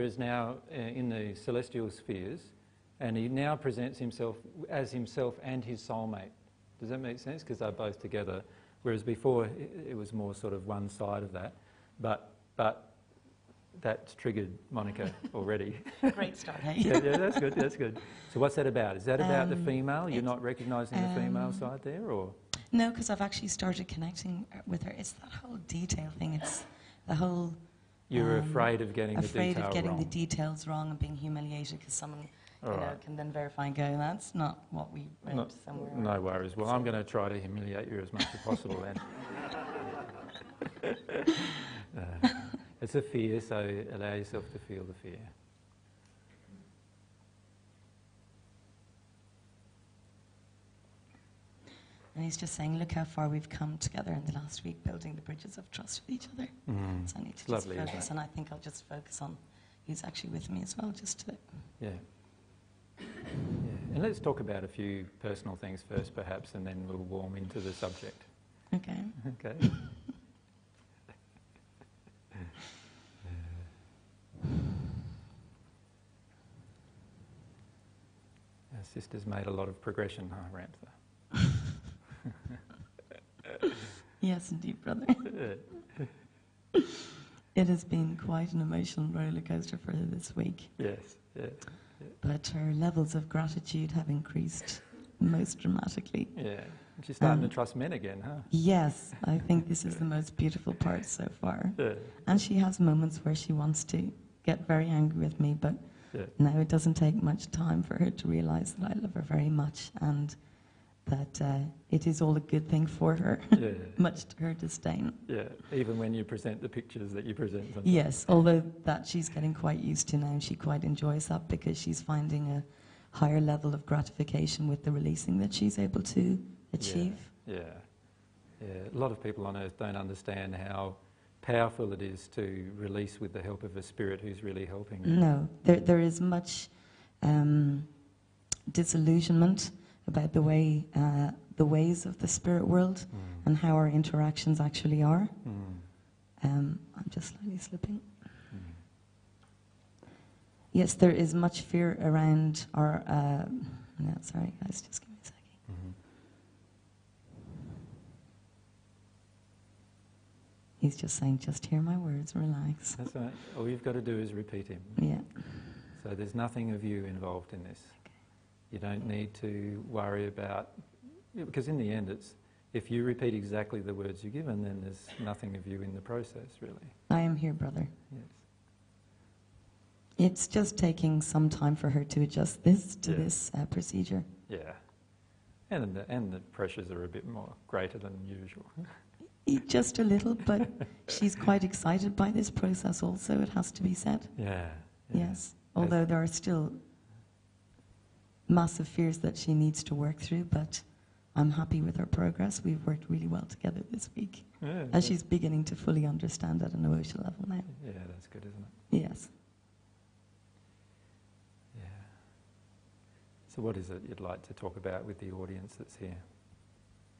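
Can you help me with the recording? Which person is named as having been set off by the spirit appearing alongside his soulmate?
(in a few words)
Monica.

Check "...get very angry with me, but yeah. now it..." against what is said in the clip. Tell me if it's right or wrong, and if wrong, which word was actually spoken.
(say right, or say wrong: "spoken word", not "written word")
right.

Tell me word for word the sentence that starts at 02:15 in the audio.
No, there, there is much um, disillusionment about the way uh, the ways of the spirit world mm.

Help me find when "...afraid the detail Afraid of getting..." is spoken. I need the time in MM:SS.
00:29.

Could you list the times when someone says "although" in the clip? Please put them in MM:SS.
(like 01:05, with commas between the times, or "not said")
01:58, 03:15.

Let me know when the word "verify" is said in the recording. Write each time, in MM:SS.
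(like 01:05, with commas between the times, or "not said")
00:33.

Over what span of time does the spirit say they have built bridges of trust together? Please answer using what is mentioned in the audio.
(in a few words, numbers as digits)
the last week.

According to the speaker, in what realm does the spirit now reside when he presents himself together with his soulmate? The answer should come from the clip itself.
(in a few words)
the celestial spheres.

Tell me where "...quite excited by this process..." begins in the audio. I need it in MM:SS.
03:11.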